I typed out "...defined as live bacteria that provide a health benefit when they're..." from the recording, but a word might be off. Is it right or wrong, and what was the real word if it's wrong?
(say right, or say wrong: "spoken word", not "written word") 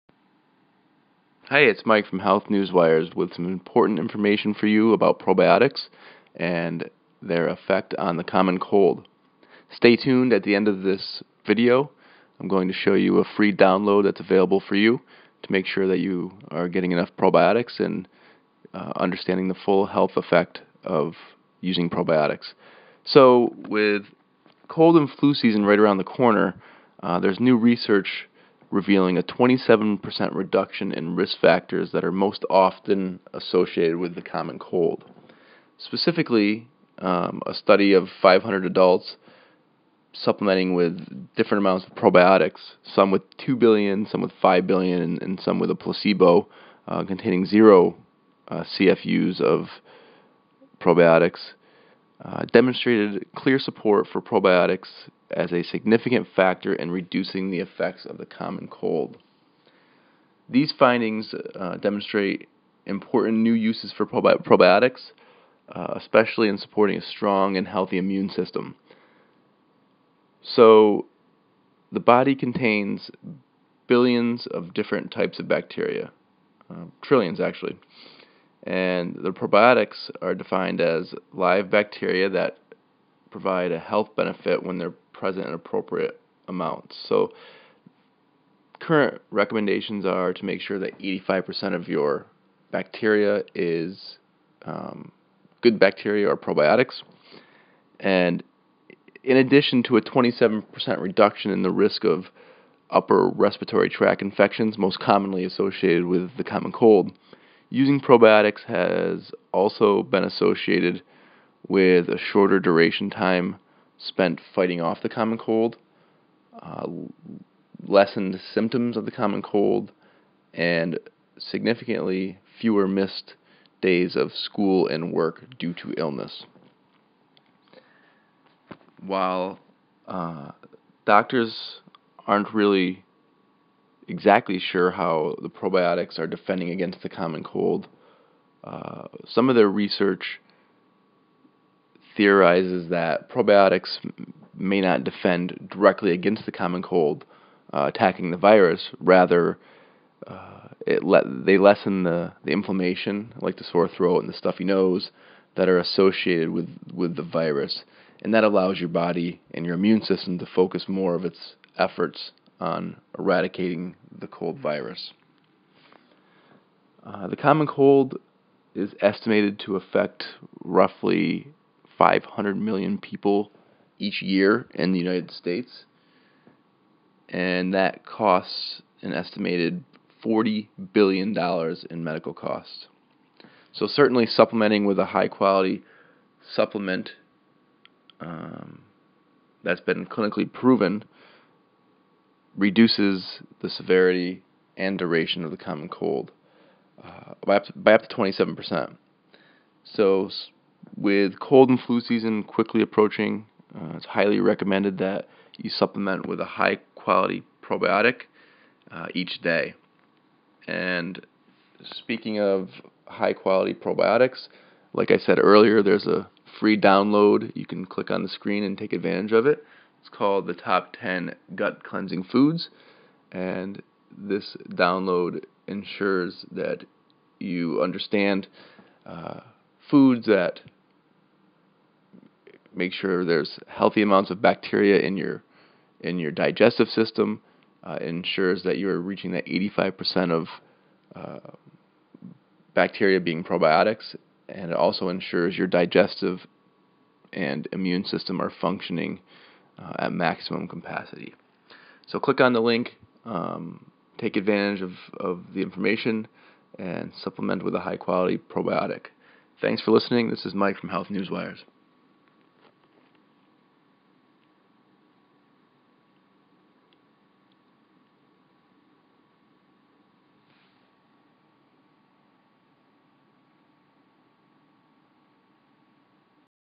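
right.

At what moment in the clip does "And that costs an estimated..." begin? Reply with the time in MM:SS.
02:57.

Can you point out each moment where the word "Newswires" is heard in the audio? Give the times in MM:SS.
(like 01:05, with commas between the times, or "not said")
00:02, 04:21.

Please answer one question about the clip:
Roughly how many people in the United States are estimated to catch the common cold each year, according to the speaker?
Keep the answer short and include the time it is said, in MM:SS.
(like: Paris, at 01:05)
500 million, at 02:52.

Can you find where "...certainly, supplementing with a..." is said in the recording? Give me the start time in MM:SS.
03:03.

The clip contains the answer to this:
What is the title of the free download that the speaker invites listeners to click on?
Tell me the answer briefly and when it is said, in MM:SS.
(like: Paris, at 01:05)
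Top 10 Gut Cleansing Foods, at 03:40.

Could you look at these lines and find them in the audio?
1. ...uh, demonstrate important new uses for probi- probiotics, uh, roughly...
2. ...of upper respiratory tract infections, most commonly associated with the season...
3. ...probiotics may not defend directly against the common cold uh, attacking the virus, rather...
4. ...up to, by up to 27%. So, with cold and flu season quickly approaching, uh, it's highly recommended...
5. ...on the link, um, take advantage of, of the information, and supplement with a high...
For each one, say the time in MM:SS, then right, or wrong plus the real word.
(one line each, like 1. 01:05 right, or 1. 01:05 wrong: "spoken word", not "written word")
1. 01:01 wrong: "especially", not "roughly"
2. 01:42 wrong: "common", not "season"
3. 02:23 right
4. 03:17 right
5. 04:12 right.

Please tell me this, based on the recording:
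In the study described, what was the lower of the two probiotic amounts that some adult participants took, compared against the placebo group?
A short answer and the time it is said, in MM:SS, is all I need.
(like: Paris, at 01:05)
2 billion, at 00:43.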